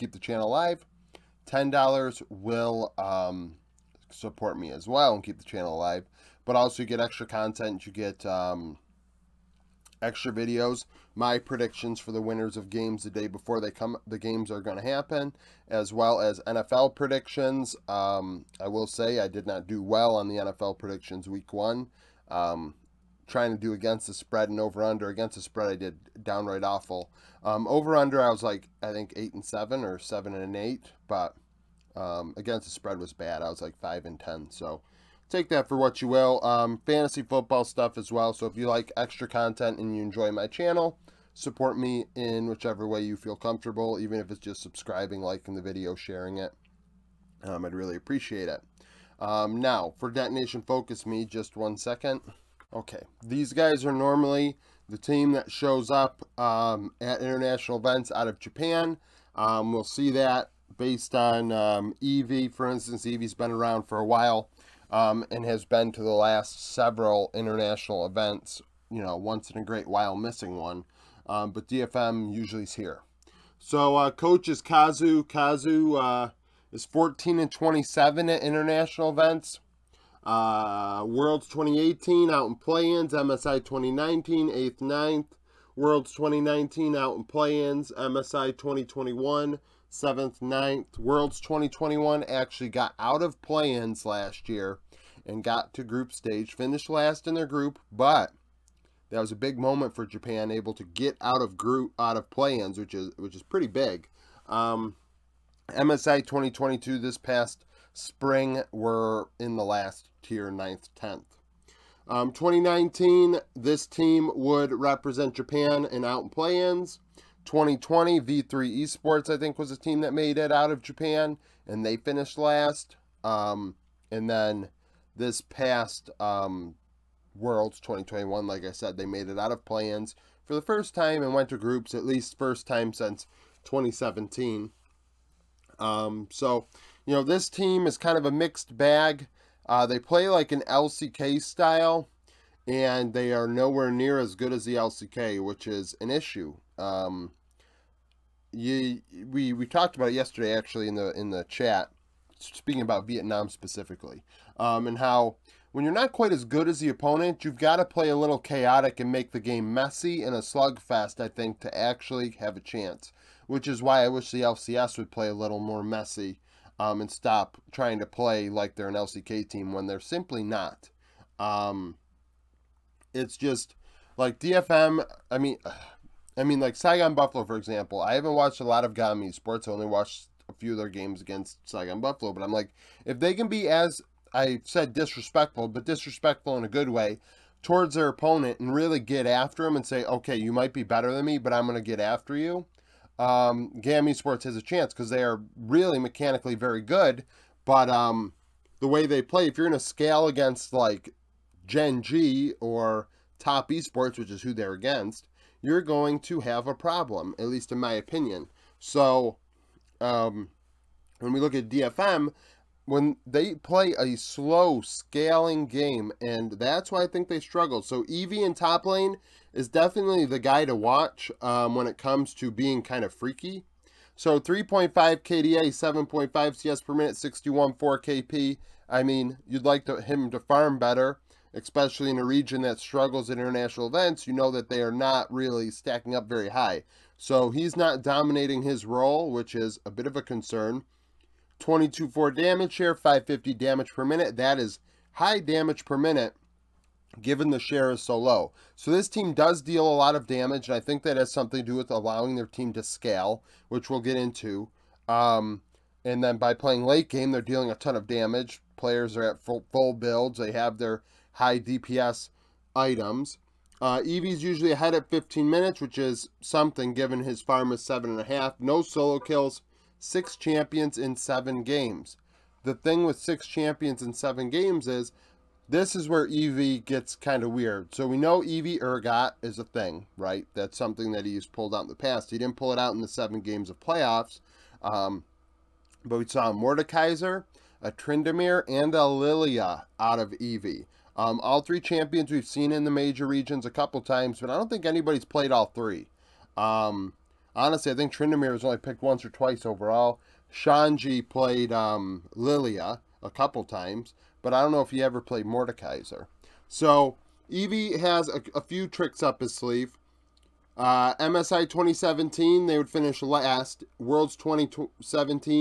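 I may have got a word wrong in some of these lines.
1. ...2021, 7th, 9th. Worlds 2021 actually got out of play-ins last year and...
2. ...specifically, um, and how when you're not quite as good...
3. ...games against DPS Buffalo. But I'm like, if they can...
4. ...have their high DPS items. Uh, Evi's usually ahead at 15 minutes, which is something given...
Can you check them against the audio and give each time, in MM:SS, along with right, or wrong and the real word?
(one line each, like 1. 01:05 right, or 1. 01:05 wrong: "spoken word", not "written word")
1. 01:28 right
2. 02:33 right
3. 03:00 wrong: "Saigon", not "DPS"
4. 04:20 right.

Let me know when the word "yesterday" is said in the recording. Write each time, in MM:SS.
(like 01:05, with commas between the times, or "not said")
02:30.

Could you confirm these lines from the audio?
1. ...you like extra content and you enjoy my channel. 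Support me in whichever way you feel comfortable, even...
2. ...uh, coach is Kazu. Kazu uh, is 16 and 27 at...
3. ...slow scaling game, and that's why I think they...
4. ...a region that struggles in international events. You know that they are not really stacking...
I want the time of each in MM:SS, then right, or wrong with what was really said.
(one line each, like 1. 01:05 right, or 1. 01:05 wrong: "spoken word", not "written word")
1. 00:38 right
2. 01:13 wrong: "14", not "16"
3. 03:34 right
4. 03:52 right.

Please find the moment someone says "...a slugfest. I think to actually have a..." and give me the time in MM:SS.
02:40.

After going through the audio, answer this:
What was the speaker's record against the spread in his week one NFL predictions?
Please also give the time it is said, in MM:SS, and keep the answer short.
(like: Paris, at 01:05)
5 and 10, at 00:33.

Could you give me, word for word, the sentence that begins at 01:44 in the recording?
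Um, MSI 2022 this past spring were in the last tier, ninth 10th.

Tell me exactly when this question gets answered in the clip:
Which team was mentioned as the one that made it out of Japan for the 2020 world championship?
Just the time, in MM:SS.
01:58.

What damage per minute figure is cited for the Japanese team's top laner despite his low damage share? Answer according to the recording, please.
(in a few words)
550.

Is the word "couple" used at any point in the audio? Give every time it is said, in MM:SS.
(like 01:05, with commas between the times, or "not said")
04:53, 05:03.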